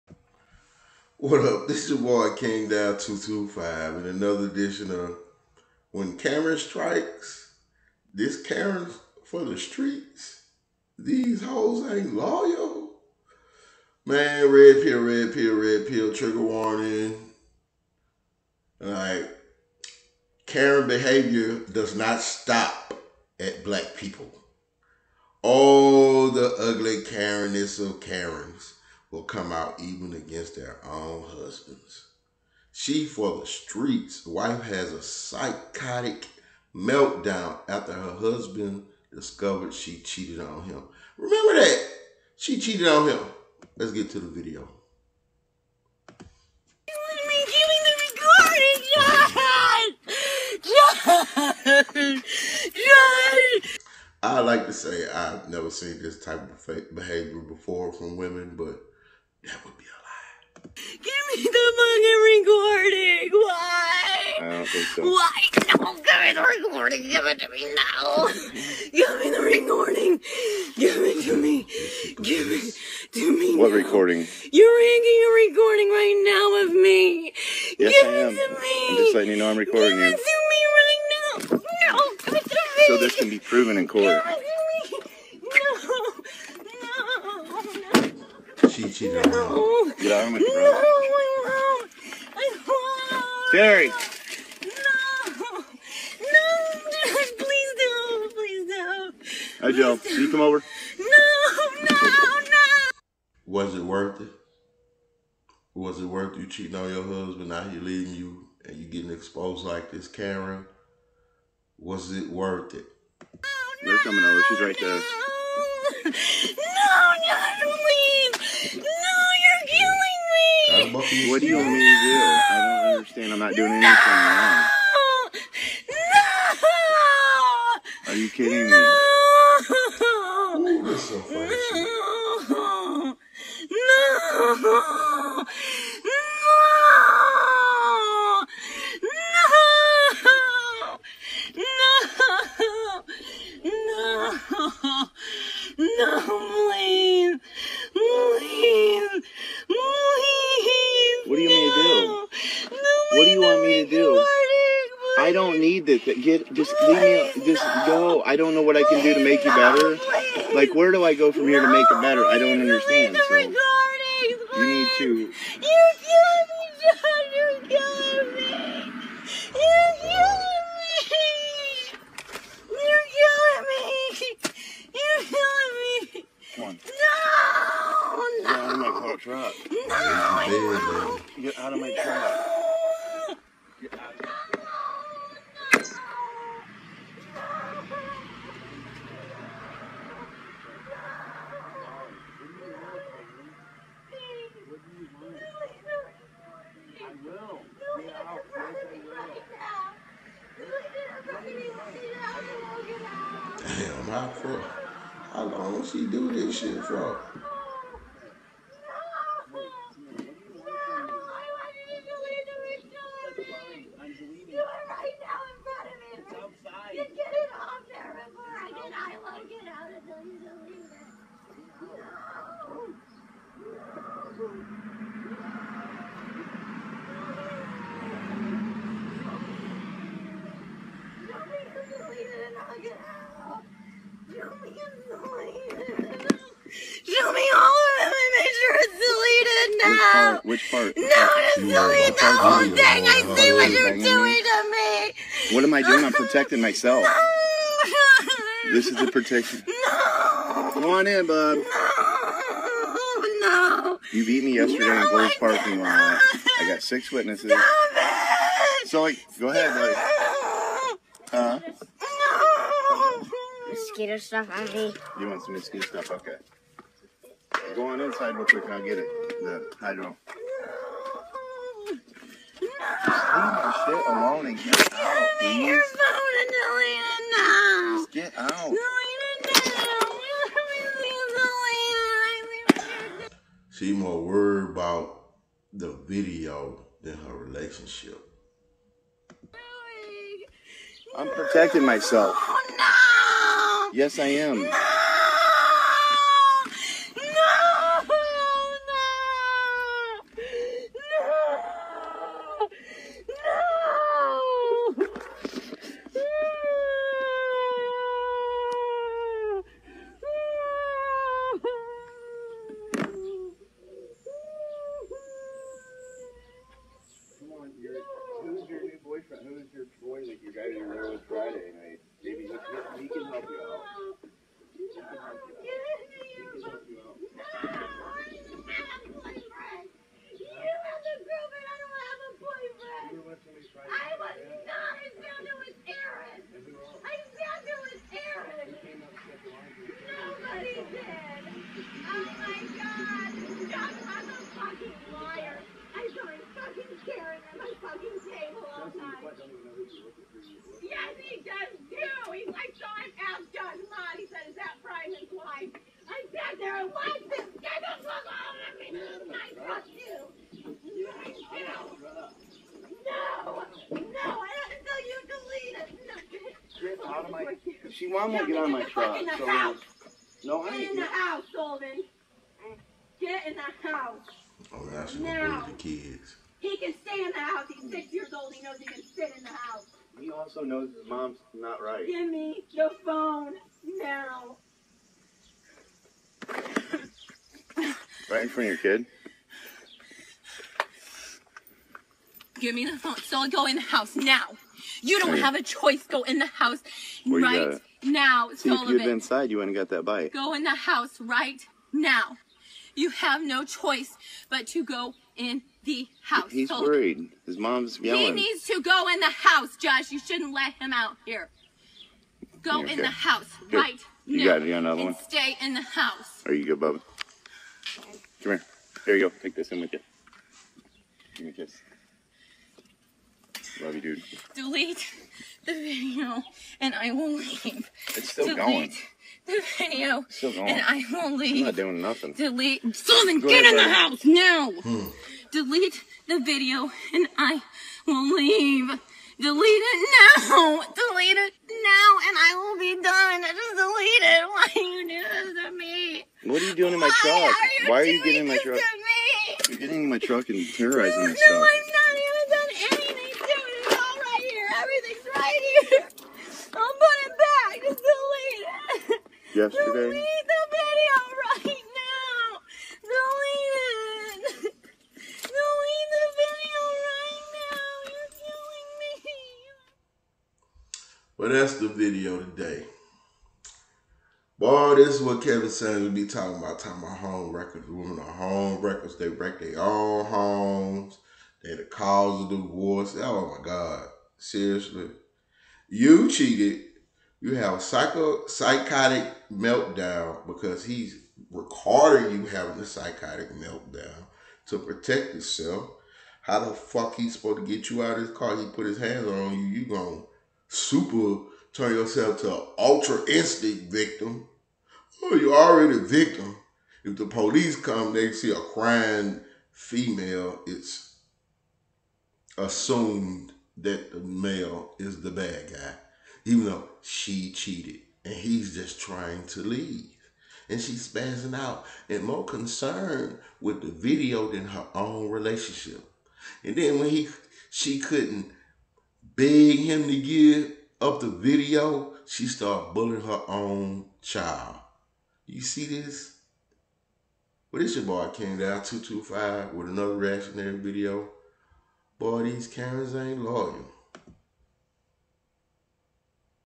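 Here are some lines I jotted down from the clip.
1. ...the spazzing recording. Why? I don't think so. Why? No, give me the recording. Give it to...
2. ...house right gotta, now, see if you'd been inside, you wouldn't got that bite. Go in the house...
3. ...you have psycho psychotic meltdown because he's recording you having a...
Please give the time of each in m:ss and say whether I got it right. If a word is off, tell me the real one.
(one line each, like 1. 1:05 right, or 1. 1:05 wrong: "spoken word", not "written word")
1. 1:01 wrong: "fucking", not "spazzing"
2. 6:36 right
3. 8:07 right.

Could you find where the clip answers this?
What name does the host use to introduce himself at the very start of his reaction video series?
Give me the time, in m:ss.
0:02.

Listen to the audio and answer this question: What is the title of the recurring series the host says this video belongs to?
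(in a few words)
When Karen Strikes.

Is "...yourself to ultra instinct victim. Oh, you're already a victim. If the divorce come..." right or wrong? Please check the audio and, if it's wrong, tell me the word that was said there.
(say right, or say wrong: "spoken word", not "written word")
wrong: "police", not "divorce".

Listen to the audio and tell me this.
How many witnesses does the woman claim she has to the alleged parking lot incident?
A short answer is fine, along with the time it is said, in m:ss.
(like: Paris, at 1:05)
6, at 4:16.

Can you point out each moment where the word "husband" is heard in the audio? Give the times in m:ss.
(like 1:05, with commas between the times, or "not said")
0:31, 0:38, 1:47.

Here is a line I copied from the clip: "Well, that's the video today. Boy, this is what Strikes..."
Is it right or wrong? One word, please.
wrong.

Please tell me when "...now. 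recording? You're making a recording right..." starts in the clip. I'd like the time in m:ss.
1:13.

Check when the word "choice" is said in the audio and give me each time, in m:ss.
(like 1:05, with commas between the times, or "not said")
6:35, 6:43.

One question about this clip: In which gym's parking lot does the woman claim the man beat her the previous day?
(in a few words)
Gold's.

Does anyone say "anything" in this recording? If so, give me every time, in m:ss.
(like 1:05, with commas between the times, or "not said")
2:03.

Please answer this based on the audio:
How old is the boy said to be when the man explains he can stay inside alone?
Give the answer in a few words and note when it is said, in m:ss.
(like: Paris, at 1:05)
6, at 6:17.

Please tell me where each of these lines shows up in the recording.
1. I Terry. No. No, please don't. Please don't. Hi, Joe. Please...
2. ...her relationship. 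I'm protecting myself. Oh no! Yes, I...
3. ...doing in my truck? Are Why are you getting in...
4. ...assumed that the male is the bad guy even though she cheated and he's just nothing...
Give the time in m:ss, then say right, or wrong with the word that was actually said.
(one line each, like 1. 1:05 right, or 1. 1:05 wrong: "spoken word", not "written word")
1. 1:32 right
2. 4:47 right
3. 7:26 right
4. 8:32 wrong: "trying", not "nothing".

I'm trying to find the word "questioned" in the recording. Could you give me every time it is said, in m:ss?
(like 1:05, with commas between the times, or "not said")
not said.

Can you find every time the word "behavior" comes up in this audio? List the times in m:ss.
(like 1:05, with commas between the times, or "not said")
0:20, 0:56.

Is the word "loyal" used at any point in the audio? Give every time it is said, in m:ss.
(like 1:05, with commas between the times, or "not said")
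0:12, 9:03.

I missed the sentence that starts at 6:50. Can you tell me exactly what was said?
You shouldn't let him out here.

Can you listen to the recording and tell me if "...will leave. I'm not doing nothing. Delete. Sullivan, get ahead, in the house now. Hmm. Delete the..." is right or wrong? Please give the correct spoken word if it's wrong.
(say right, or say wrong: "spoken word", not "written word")
right.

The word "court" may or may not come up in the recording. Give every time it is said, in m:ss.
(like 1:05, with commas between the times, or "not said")
1:23.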